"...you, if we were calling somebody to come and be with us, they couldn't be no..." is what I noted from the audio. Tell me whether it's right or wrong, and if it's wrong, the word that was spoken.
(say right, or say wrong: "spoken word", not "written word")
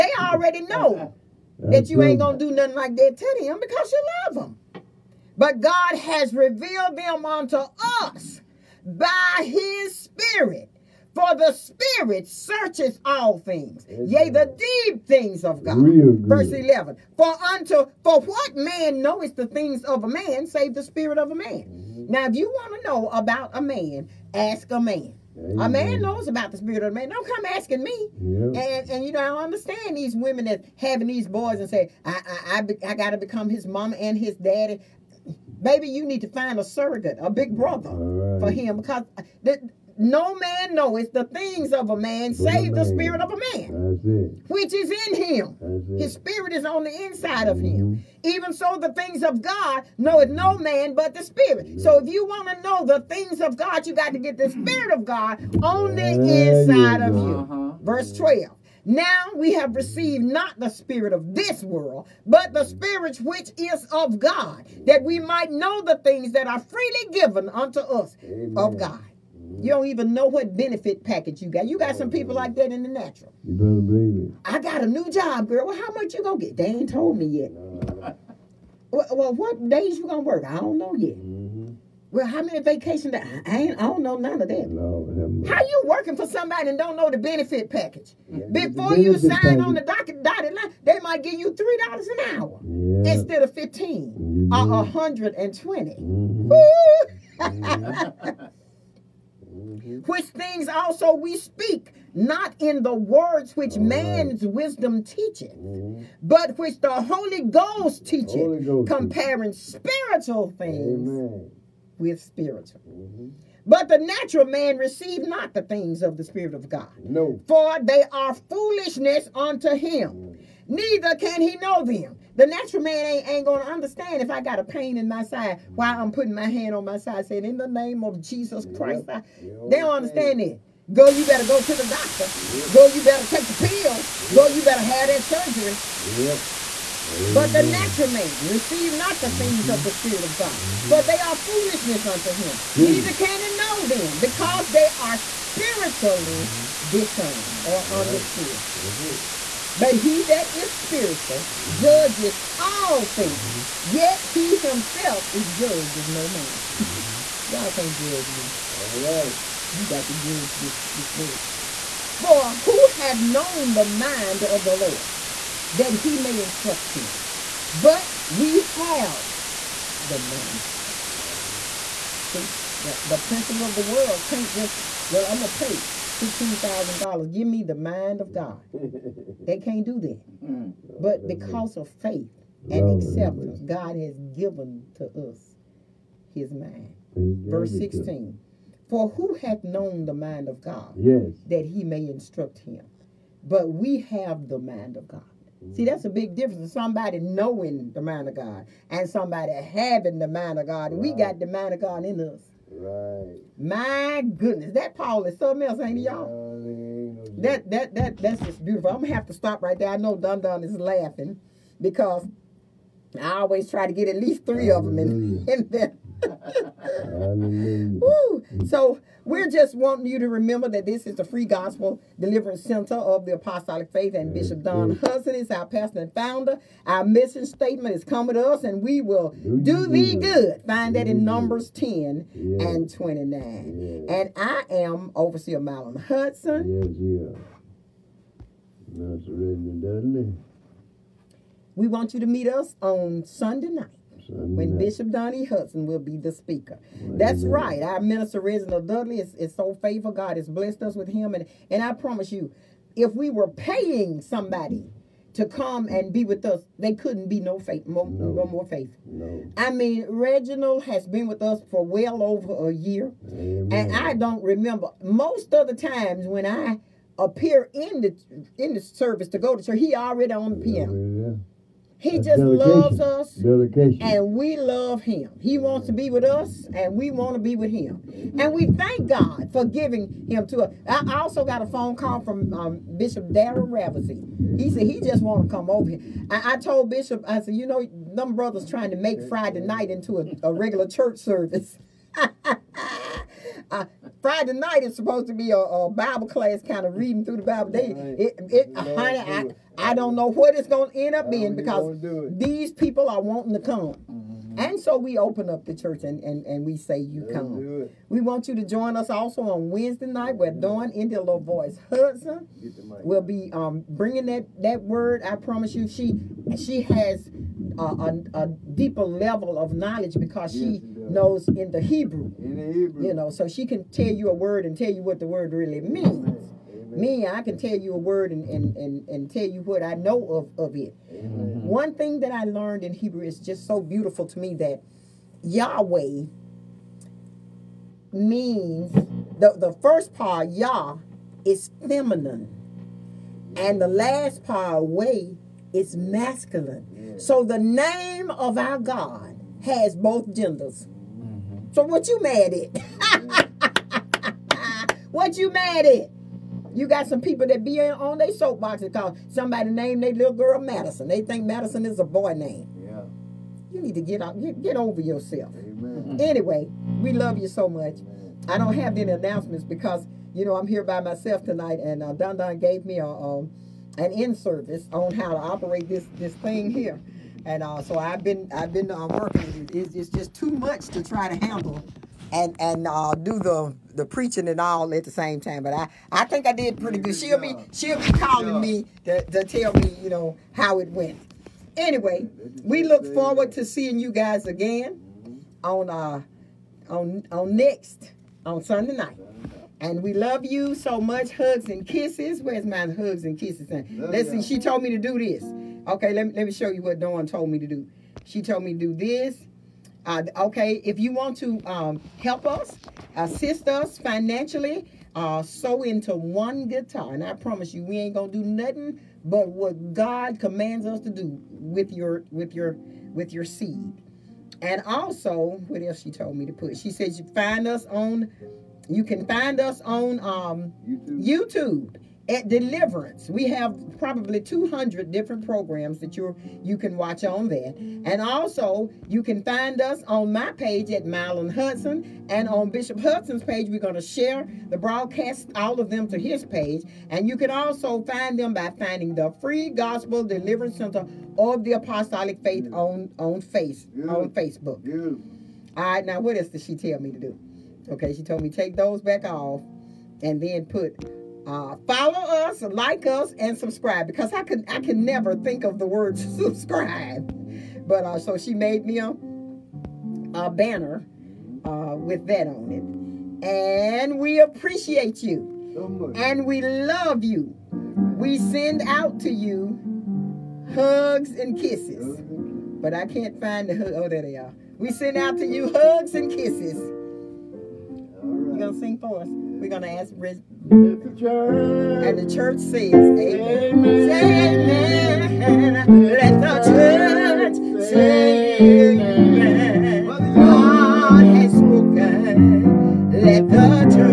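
wrong: "paying", not "calling".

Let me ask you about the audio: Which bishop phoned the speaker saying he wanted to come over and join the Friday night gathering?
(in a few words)
Bishop Darren Ravesey.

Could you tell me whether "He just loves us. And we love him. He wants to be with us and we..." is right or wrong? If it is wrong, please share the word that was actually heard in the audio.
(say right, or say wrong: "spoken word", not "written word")
right.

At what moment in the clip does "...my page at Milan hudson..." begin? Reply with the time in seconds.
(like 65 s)
440 s.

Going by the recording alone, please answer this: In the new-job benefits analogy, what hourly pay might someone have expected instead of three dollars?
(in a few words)
15.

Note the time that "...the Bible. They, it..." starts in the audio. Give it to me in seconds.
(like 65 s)
297 s.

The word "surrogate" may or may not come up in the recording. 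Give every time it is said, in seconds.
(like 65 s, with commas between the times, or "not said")
36 s.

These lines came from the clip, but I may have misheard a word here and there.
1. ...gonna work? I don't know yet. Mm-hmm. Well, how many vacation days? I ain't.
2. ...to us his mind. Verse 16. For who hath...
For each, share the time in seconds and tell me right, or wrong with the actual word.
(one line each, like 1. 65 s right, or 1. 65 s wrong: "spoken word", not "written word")
1. 80 s right
2. 184 s right.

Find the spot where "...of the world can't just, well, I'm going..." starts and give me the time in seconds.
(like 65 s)
173 s.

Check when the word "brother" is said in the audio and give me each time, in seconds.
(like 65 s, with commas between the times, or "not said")
37 s, 288 s.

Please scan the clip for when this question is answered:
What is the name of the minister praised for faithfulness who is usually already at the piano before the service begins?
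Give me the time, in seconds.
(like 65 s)
248 s.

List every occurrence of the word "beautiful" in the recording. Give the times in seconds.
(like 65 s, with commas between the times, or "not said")
208 s, 333 s.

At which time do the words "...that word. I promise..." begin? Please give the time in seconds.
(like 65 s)
314 s.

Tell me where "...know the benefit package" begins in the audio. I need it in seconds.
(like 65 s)
86 s.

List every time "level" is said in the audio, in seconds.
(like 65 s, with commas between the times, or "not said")
319 s.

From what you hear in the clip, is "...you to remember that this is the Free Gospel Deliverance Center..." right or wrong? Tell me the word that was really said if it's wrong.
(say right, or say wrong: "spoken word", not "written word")
right.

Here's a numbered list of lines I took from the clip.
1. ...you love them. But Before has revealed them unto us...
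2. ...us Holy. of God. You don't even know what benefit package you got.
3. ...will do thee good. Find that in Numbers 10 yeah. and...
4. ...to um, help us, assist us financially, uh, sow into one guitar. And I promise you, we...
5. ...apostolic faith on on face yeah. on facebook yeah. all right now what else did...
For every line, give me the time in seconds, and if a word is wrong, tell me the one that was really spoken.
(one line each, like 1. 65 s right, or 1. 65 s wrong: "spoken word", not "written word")
1. 3 s wrong: "God", not "Before"
2. 68 s wrong: "Amen", not "Holy"
3. 229 s right
4. 411 s right
5. 451 s right.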